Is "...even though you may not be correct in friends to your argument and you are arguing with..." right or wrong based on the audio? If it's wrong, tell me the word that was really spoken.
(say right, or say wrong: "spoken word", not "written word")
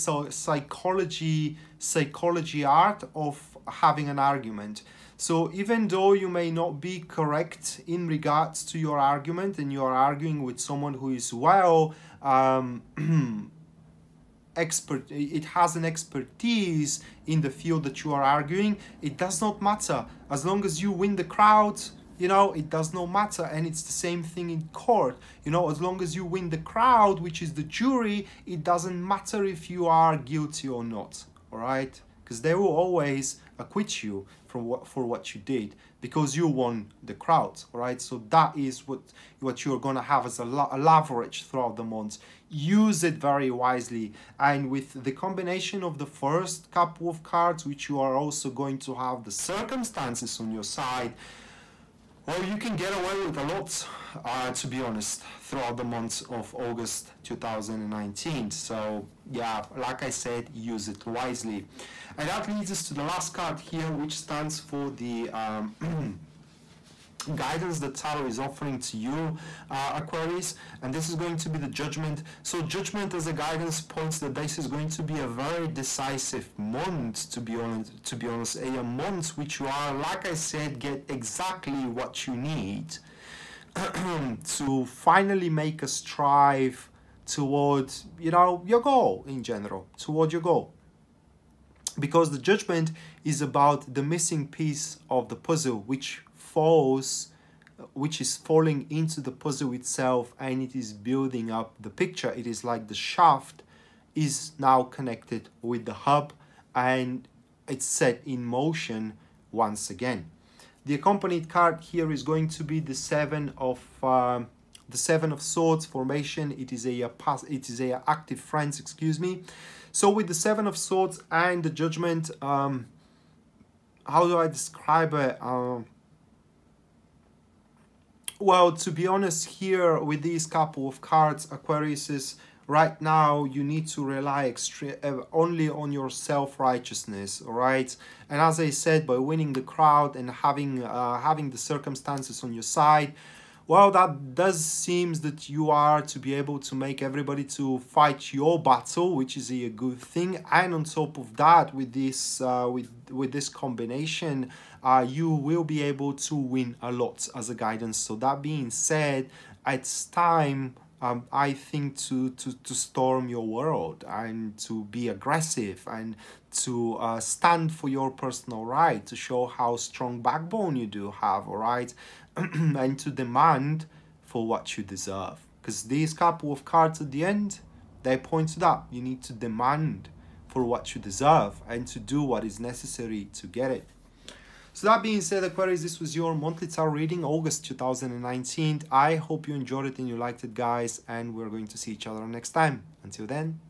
wrong: "regards", not "friends".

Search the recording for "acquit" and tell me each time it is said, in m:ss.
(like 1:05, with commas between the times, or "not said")
0:33.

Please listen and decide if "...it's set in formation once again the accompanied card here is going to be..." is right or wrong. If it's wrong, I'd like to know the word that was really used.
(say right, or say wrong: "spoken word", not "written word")
wrong: "motion", not "formation".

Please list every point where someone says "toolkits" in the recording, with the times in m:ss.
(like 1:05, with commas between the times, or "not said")
not said.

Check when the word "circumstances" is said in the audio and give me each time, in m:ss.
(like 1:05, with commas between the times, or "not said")
0:49, 2:21.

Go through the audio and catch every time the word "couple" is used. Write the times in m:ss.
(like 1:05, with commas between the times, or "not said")
0:46, 2:10, 2:56.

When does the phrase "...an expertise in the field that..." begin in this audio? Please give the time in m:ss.
0:15.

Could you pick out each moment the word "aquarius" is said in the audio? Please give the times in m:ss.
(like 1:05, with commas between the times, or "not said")
1:09, 2:11, 3:05.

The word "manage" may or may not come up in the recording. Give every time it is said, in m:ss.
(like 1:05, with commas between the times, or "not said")
not said.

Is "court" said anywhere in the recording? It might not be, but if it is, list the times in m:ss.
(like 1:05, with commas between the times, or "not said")
0:24.